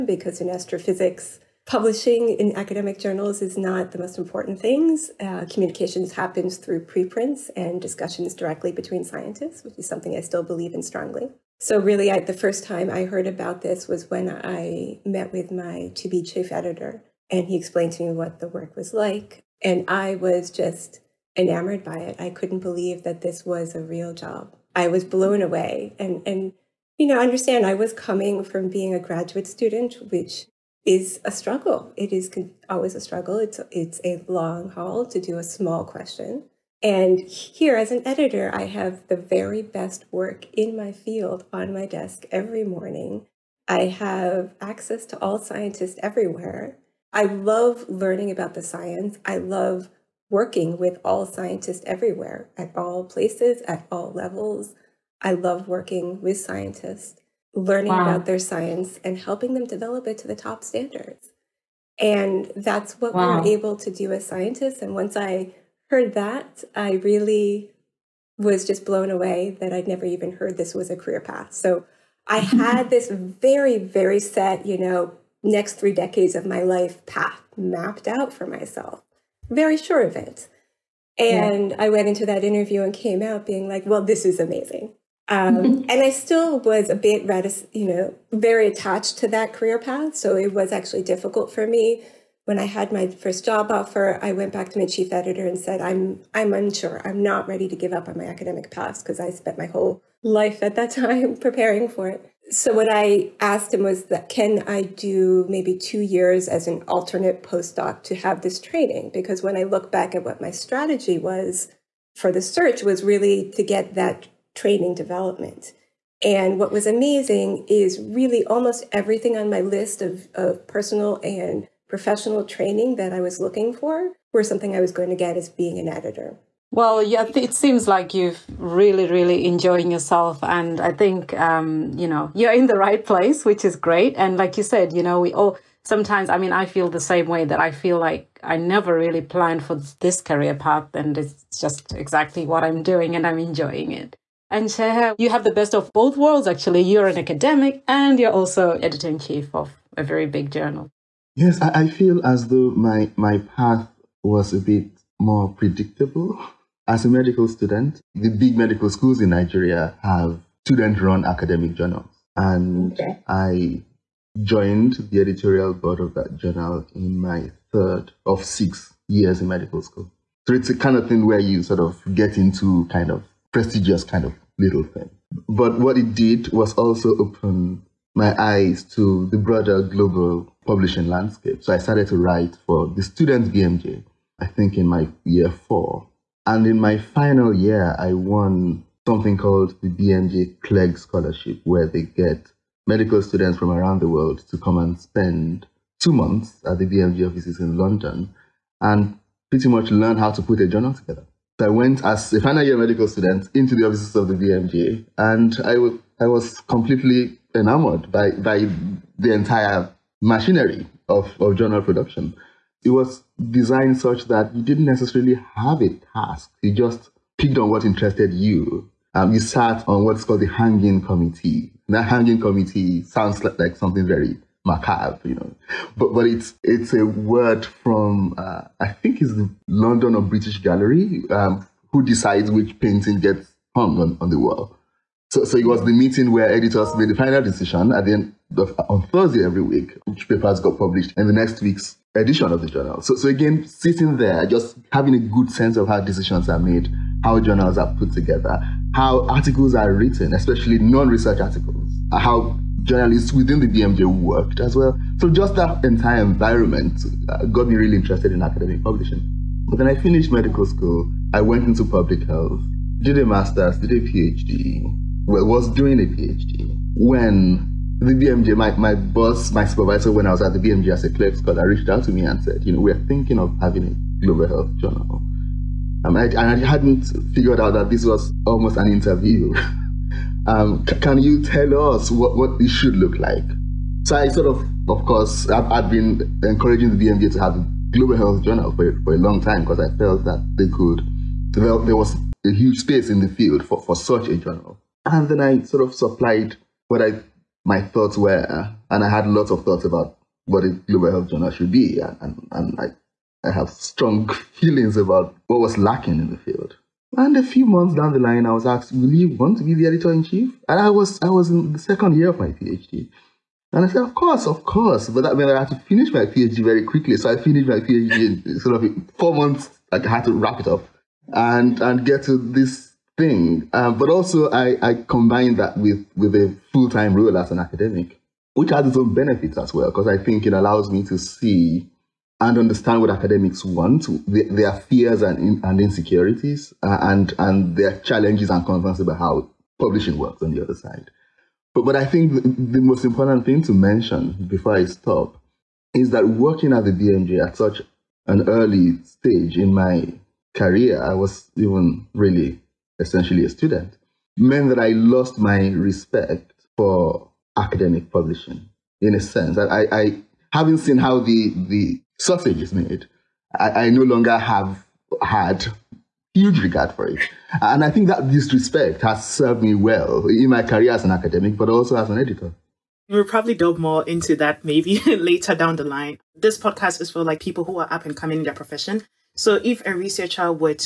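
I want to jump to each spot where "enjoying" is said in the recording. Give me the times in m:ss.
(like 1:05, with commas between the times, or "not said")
2:09, 2:23.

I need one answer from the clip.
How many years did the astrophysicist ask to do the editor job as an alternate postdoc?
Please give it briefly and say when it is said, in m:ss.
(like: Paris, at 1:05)
2 years, at 1:45.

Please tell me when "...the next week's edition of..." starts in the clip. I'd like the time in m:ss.
4:01.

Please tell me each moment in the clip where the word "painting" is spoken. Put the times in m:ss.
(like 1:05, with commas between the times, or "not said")
3:52.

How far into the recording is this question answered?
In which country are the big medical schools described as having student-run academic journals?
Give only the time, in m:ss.
2:39.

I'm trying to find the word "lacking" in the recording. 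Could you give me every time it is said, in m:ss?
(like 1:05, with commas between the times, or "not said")
5:05.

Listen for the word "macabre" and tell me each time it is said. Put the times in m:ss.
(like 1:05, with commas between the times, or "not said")
3:44.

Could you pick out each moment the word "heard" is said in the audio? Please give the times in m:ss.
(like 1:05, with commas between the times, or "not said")
0:13, 1:05, 1:10.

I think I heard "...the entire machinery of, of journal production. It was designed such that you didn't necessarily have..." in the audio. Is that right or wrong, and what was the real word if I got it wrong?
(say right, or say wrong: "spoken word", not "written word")
right.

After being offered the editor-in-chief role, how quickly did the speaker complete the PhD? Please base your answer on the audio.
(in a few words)
4 months.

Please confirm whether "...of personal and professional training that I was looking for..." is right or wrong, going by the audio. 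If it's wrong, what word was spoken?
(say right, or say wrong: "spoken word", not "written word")
right.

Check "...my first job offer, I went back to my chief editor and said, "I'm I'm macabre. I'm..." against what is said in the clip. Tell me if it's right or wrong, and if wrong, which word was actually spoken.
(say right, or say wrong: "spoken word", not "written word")
wrong: "unsure", not "macabre".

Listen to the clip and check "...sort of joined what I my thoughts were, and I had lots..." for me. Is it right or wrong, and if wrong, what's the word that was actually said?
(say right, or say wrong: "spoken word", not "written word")
wrong: "supplied", not "joined".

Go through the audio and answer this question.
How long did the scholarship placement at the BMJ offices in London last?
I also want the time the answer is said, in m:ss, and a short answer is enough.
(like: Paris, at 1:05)
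2 months, at 3:16.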